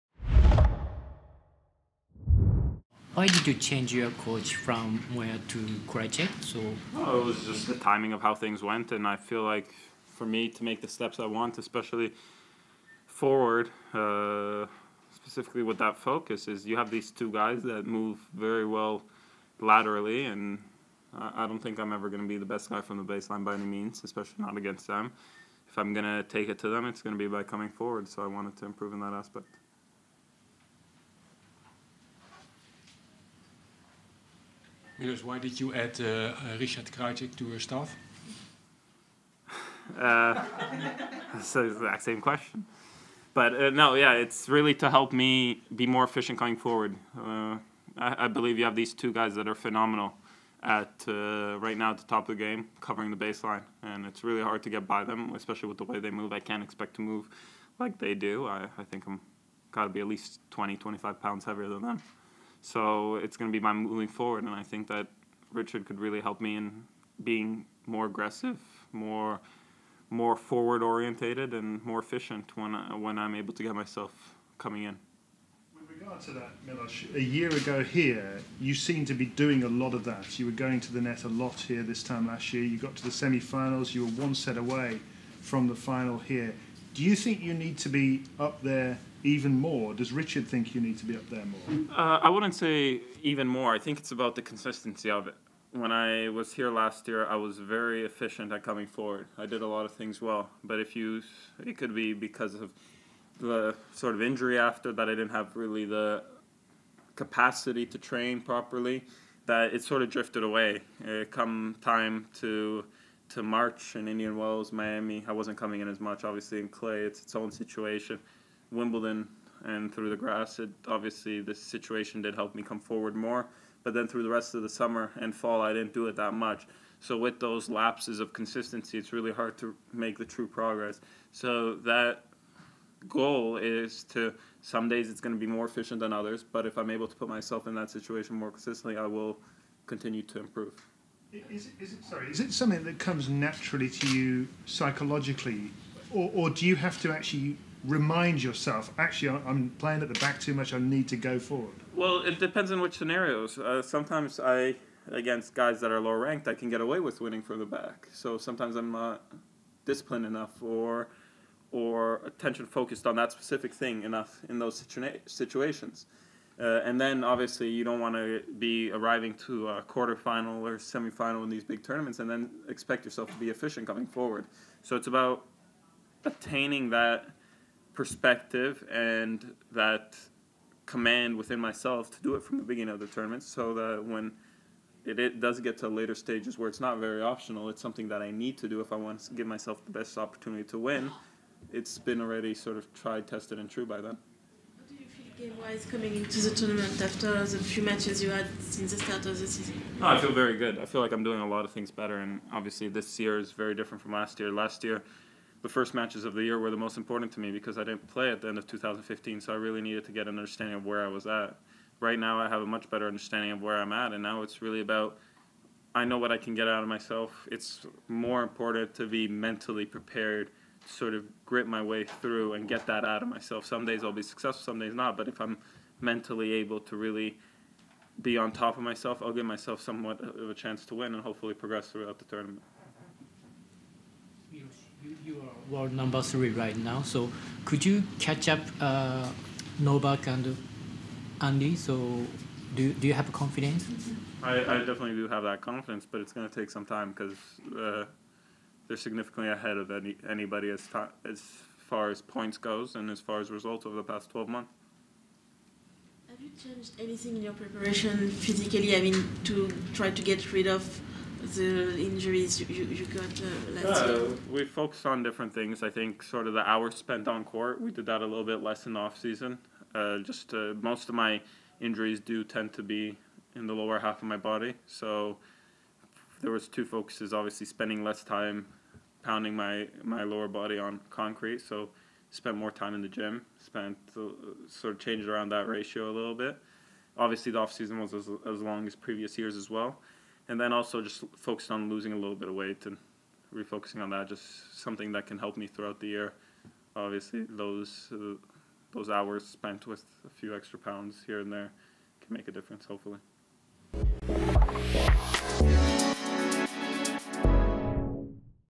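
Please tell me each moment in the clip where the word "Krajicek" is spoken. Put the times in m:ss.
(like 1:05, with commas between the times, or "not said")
0:05, 0:36.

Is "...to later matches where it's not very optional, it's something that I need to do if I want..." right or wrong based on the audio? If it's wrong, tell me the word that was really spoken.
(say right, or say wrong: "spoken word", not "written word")
wrong: "stages", not "matches".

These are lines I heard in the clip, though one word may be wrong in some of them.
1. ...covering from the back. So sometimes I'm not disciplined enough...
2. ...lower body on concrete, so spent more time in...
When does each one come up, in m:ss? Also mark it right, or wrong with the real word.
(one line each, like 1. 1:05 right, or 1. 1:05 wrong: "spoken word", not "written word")
1. 2:37 wrong: "winning", not "covering"
2. 4:40 right.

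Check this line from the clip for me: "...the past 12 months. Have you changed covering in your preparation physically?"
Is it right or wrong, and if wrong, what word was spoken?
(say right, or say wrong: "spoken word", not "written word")
wrong: "anything", not "covering".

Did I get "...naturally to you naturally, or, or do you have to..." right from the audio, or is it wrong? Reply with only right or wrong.
wrong.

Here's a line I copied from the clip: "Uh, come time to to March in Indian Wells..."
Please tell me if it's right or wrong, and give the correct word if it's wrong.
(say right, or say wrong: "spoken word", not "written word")
right.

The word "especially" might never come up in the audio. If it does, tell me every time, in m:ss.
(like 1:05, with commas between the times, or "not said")
0:11, 0:24, 0:55.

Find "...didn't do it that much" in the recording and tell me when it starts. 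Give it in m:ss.
2:05.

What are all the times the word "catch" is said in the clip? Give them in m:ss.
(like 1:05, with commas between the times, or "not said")
3:58.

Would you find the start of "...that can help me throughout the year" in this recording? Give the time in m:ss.
4:55.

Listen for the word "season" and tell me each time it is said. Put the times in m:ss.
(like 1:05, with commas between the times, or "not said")
3:19, 4:29, 4:47.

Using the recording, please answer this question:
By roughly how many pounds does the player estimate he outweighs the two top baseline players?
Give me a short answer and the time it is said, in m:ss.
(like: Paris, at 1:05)
20, 25 pounds, at 1:00.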